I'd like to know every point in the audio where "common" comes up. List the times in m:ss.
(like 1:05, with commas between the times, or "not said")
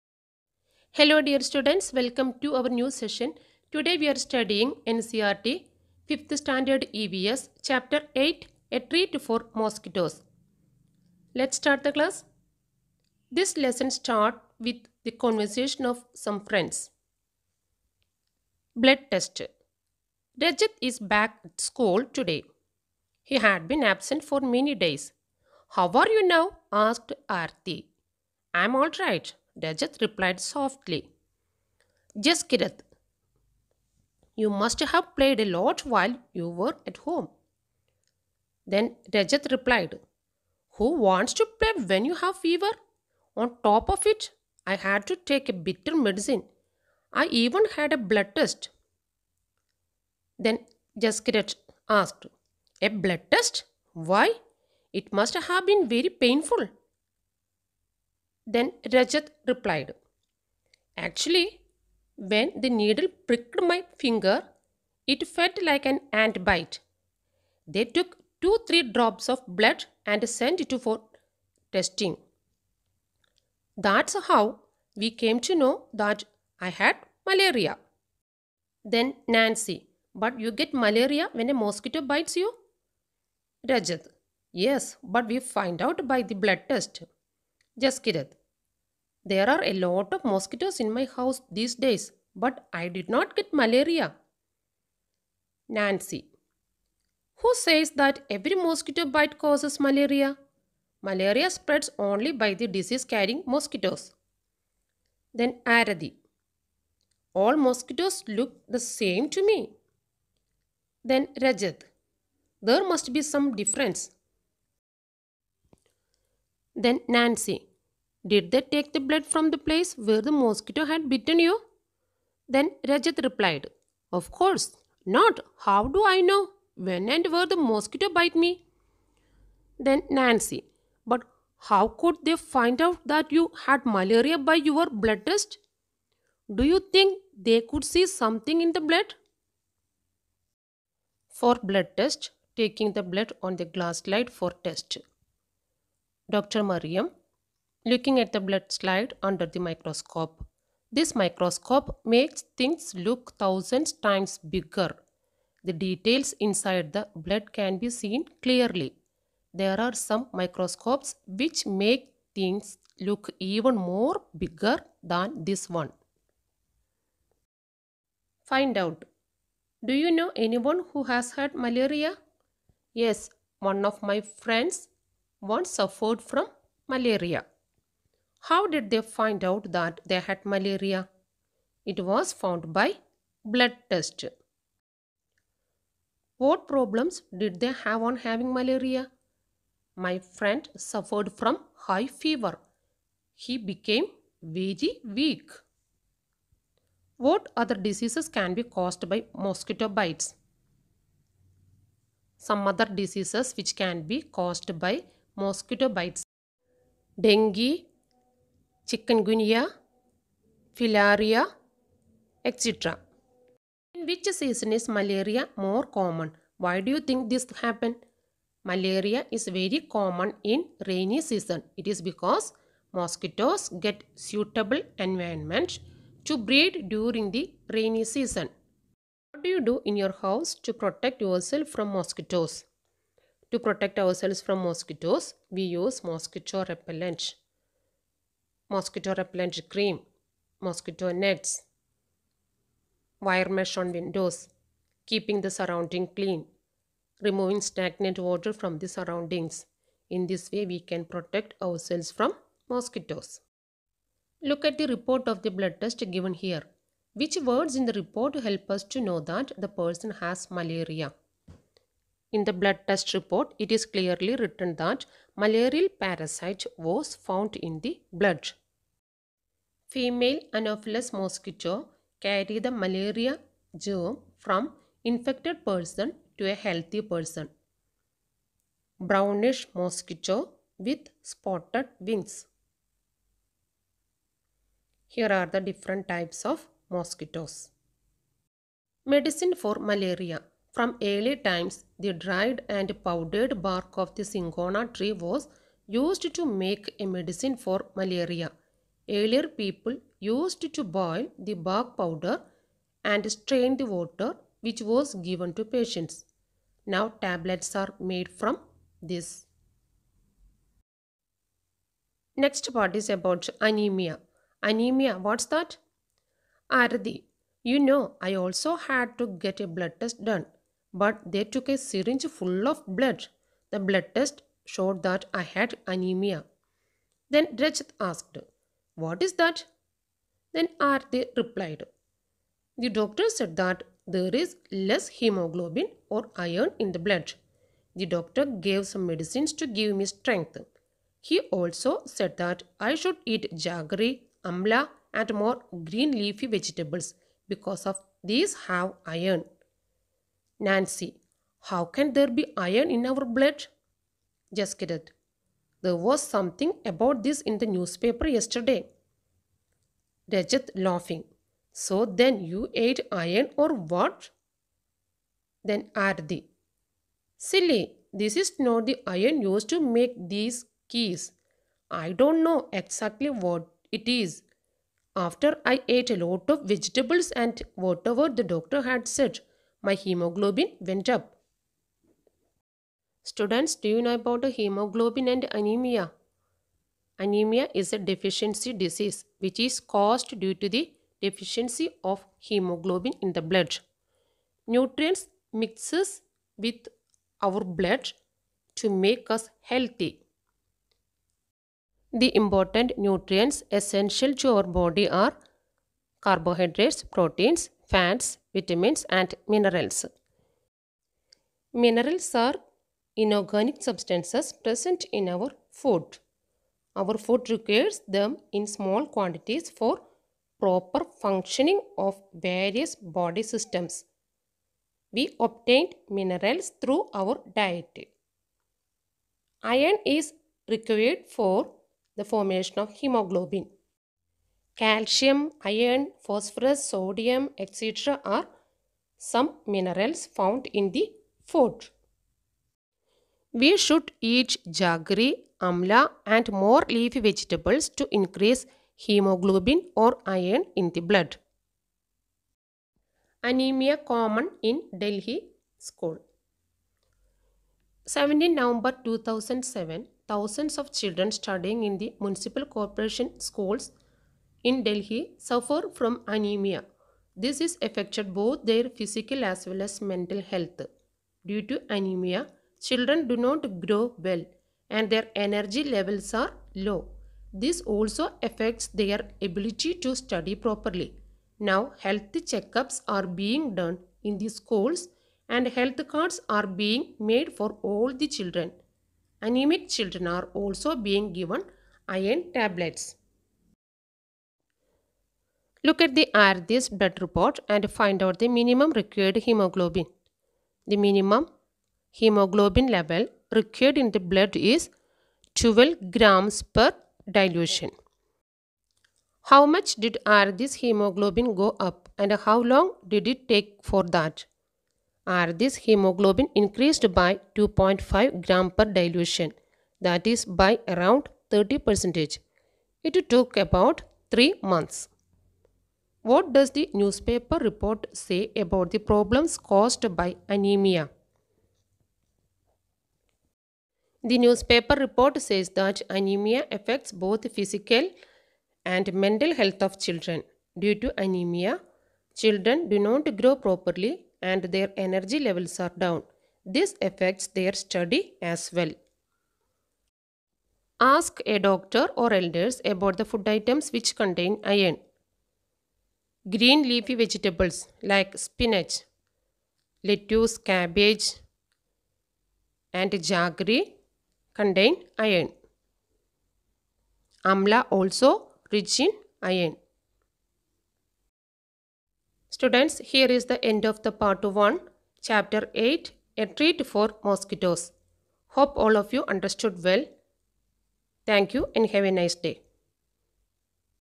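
3:35, 3:39, 7:33.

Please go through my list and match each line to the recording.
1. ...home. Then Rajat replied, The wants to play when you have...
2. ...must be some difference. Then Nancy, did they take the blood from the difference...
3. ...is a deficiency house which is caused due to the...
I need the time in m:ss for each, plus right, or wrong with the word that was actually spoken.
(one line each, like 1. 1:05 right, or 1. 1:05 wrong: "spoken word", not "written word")
1. 0:36 wrong: "Who", not "The"
2. 1:52 wrong: "place", not "difference"
3. 6:27 wrong: "disease", not "house".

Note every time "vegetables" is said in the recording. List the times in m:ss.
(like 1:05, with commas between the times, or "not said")
5:46, 6:16, 7:27, 9:17.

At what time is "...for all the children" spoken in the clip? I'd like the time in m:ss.
8:07.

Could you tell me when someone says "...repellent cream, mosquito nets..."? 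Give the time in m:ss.
3:59.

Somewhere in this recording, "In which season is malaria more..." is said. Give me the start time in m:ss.
3:33.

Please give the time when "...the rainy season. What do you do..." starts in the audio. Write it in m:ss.
3:47.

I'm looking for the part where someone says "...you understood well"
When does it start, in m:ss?
9:39.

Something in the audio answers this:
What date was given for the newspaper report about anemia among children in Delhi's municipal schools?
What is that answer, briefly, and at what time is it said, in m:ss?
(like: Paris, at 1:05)
17 November 2007, at 7:38.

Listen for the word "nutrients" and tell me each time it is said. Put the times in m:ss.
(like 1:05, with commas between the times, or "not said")
6:34, 6:42.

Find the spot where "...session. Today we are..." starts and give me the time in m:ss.
0:02.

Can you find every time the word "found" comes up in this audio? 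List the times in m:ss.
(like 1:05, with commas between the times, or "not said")
3:02, 4:27, 7:20.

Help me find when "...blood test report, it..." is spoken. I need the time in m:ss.
4:22.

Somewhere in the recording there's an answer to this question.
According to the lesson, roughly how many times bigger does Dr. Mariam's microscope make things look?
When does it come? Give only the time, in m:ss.
2:33.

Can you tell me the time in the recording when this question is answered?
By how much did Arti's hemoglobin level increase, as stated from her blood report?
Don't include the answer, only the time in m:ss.
8:37.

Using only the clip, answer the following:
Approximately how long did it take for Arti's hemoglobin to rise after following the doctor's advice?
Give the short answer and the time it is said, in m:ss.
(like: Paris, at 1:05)
3 months, at 8:44.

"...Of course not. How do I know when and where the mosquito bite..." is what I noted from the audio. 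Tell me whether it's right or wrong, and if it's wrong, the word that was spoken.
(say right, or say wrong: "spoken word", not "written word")
right.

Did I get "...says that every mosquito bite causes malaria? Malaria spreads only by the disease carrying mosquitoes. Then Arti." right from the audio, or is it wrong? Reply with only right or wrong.
right.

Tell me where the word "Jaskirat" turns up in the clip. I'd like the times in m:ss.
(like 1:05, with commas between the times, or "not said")
0:32, 0:50, 1:27, 5:54.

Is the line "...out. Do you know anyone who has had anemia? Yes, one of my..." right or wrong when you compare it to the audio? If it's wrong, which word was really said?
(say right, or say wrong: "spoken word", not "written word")
wrong: "malaria", not "anemia".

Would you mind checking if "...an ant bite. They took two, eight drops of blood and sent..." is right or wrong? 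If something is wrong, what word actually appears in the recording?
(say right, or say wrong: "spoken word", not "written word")
wrong: "three", not "eight".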